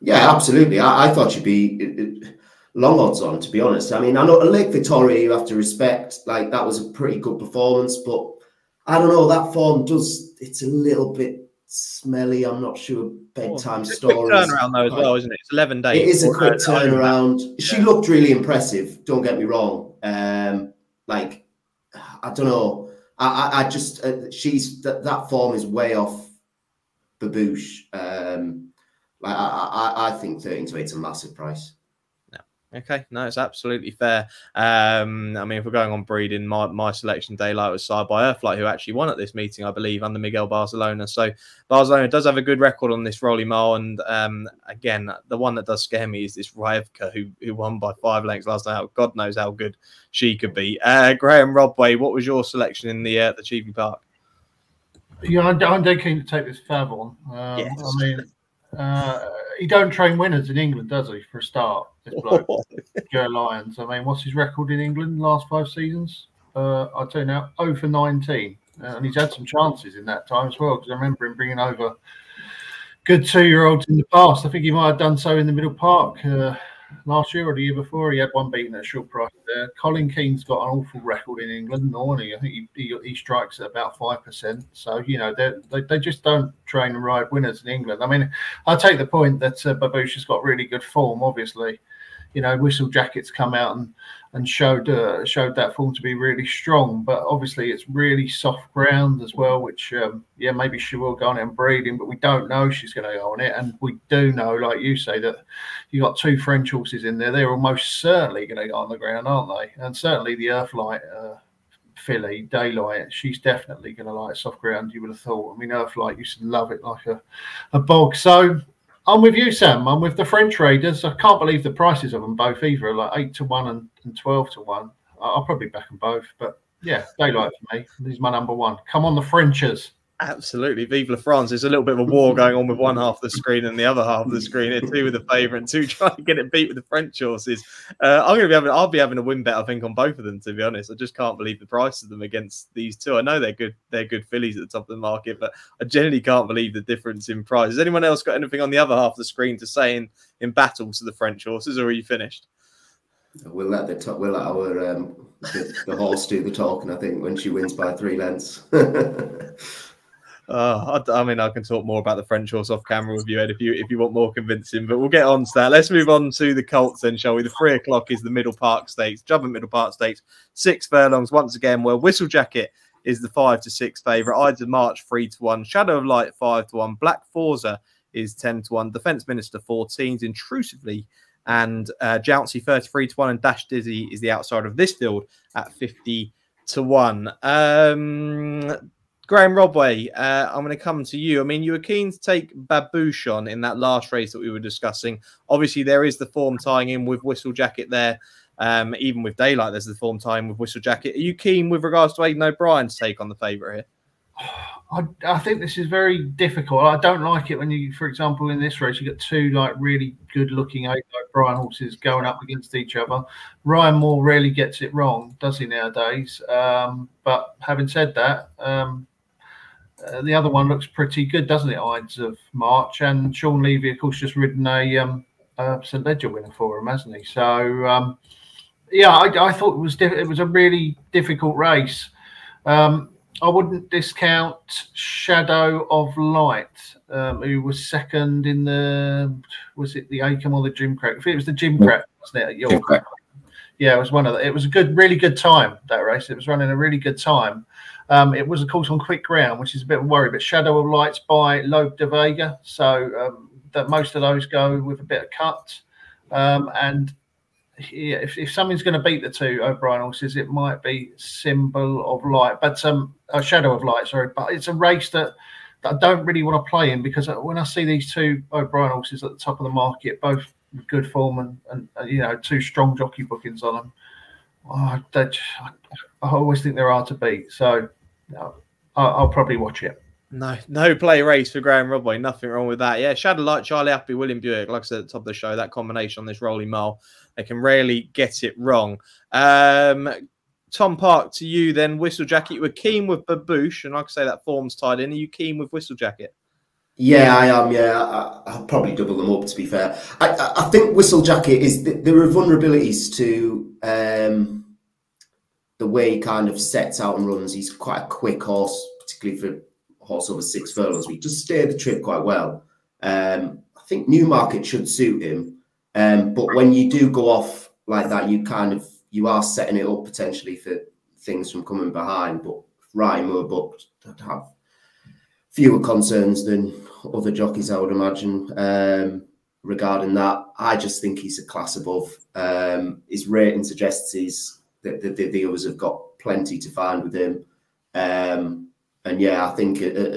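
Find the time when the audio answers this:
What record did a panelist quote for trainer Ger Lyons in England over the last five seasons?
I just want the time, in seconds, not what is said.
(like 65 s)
67 s.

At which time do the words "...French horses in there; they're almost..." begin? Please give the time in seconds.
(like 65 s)
106 s.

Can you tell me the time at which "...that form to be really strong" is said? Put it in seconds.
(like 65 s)
95 s.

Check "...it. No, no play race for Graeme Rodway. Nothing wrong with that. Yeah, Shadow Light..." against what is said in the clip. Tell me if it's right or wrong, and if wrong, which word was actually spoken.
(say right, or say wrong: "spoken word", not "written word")
right.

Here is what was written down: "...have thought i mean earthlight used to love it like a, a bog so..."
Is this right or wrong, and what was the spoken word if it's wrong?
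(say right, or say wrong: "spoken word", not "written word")
right.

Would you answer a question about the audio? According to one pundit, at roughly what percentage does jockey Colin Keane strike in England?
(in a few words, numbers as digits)
5%.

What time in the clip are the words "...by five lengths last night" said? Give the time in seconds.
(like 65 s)
47 s.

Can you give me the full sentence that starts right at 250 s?
But Shadow of Lights by Lope de Vega, so um, that most of those go with a bit of cut.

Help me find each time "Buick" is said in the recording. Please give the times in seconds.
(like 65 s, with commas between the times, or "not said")
284 s.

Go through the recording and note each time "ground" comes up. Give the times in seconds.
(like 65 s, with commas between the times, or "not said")
98 s, 108 s, 114 s, 249 s.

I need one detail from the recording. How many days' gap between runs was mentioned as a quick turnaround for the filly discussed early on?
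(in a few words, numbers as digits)
11.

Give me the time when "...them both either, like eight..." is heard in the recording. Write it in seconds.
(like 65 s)
122 s.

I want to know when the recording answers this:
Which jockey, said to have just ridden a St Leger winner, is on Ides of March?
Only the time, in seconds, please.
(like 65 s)
223 s.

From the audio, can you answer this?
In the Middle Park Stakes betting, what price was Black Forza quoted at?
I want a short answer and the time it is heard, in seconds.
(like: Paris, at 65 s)
10 to 1, at 178 s.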